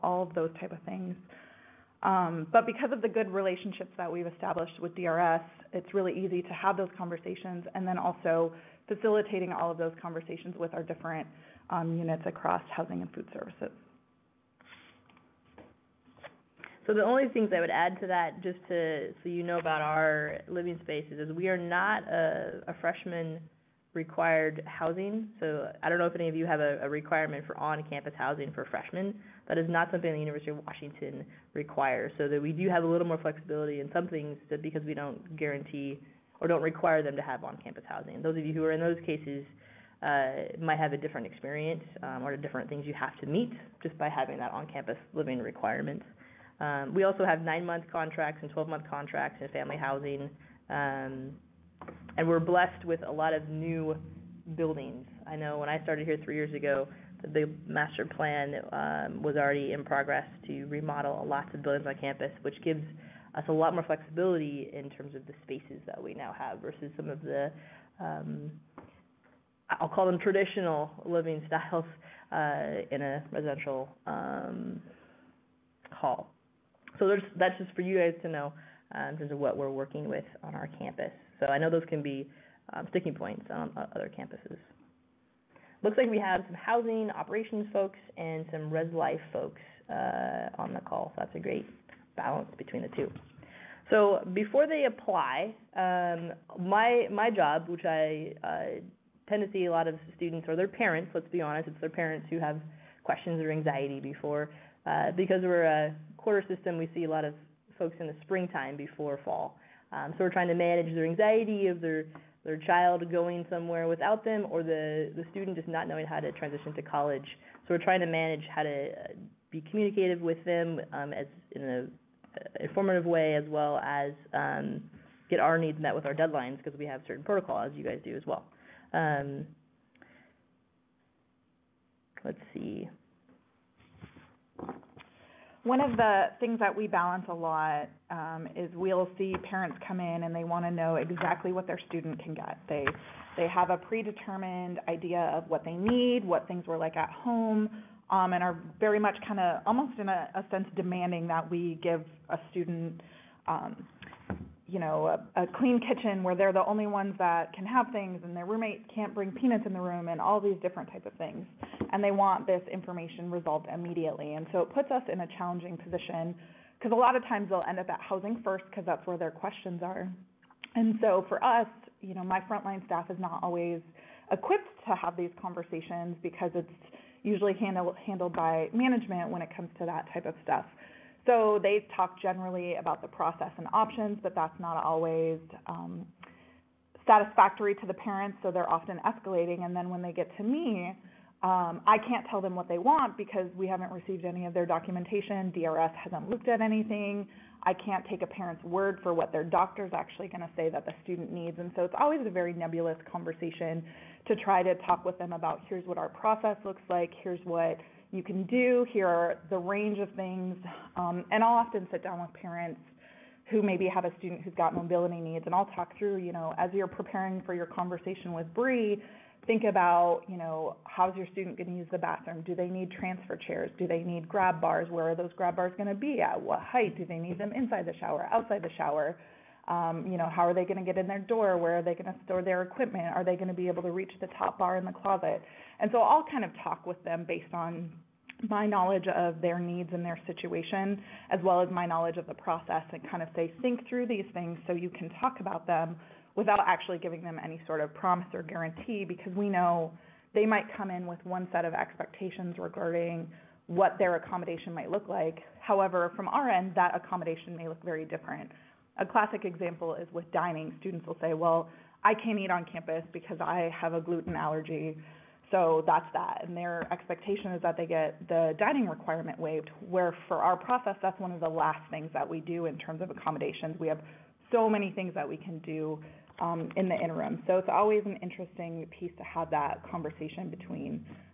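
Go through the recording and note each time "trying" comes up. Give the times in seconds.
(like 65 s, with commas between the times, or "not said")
110 s, 117 s.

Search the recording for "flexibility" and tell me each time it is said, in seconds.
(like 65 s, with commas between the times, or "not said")
33 s, 63 s.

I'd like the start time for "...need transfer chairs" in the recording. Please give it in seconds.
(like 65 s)
222 s.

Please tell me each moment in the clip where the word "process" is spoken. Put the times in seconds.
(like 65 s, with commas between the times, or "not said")
183 s, 206 s, 242 s, 270 s.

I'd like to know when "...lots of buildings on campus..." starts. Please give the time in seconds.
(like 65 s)
61 s.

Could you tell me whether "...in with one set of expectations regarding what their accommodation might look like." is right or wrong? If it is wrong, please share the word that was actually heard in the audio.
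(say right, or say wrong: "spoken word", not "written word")
right.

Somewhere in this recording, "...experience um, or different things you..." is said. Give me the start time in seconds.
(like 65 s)
41 s.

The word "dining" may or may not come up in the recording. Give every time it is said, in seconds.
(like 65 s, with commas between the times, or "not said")
260 s, 268 s.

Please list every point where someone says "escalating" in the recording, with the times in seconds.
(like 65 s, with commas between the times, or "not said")
189 s.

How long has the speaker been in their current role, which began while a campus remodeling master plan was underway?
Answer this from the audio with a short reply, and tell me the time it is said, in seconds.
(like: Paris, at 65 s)
3 years, at 56 s.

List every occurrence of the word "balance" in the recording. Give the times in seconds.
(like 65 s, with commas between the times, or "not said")
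92 s, 136 s.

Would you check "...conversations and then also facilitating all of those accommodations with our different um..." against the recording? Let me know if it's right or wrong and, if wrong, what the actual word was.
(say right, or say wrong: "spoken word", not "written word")
wrong: "conversations", not "accommodations".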